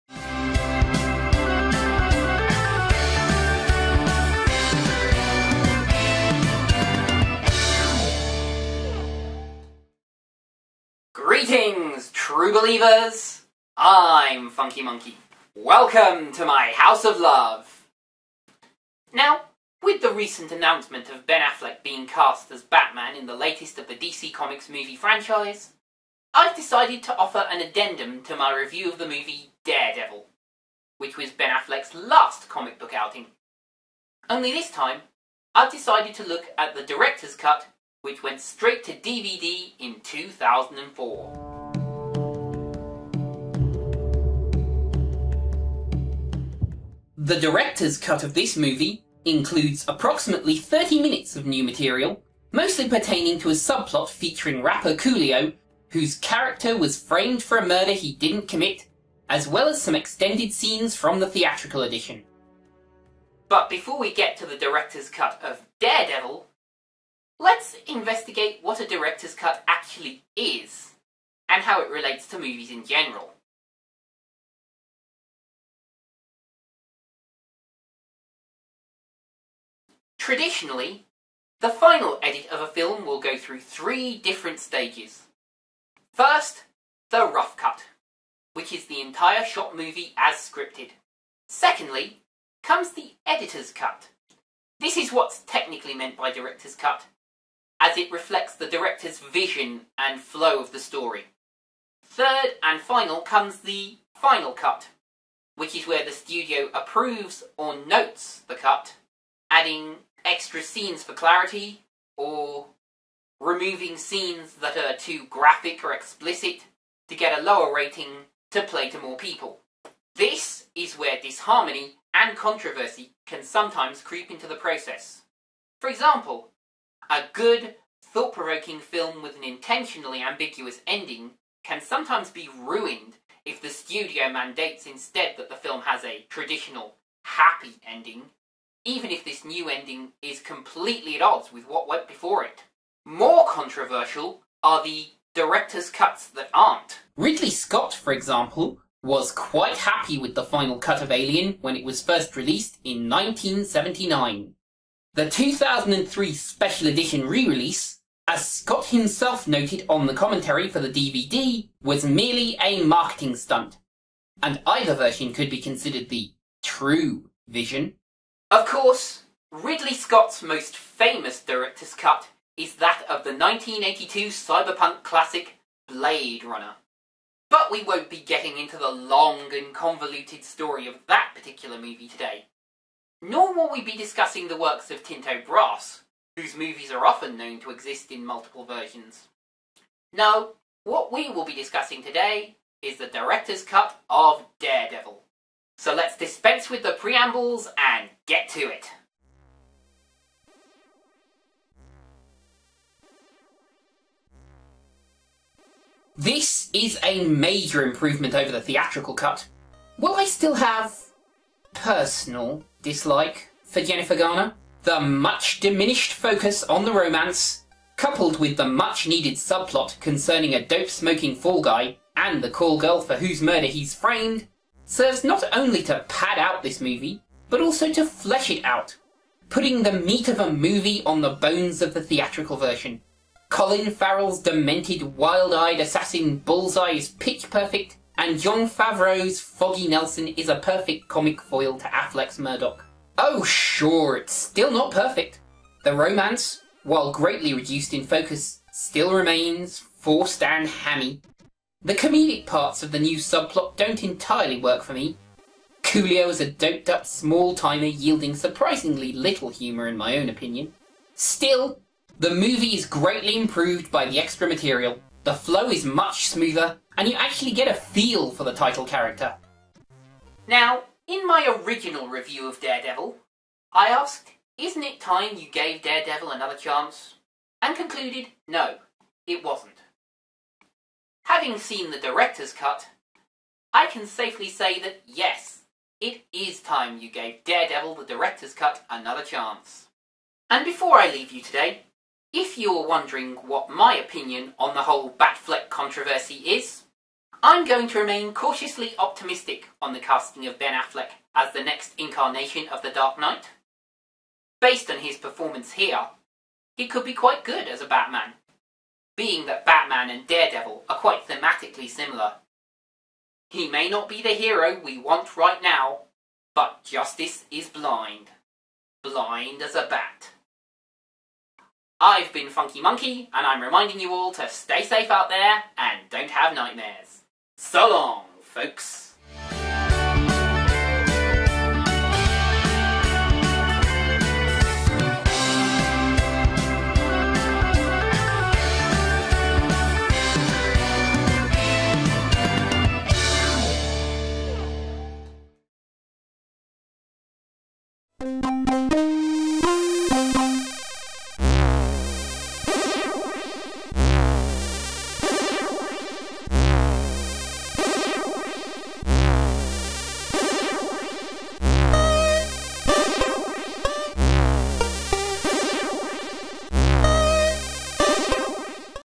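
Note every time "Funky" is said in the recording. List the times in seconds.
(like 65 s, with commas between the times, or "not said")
14 s, 322 s.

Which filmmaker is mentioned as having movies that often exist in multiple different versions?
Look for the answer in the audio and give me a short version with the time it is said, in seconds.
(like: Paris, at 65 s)
Tinto Brass, at 185 s.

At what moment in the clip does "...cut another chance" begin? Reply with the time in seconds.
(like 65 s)
288 s.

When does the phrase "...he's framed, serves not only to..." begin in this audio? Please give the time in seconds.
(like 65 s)
223 s.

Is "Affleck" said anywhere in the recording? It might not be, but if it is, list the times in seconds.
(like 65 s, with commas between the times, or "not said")
21 s, 31 s, 241 s, 300 s.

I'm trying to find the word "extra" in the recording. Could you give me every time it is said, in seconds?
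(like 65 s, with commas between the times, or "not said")
110 s, 264 s.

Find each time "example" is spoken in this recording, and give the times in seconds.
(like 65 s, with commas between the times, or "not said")
125 s, 148 s.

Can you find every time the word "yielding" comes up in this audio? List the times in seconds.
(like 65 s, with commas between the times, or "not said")
257 s.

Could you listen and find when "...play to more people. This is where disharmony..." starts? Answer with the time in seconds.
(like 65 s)
118 s.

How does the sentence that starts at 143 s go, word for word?
More controversial are the director's cuts that aren't.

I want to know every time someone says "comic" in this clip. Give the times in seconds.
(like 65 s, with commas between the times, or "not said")
24 s, 32 s, 241 s.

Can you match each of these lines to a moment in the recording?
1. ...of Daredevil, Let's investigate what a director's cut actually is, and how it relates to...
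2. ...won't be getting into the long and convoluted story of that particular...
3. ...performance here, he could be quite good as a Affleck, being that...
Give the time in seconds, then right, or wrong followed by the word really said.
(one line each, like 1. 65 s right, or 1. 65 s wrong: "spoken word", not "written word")
1. 65 s right
2. 177 s right
3. 305 s wrong: "Batman", not "Affleck".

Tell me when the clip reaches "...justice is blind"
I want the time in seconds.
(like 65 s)
316 s.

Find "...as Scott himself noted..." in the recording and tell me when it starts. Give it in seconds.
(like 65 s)
158 s.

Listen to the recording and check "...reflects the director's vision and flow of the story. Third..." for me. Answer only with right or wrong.
right.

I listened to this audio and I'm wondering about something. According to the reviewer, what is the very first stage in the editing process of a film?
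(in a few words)
The rough cut.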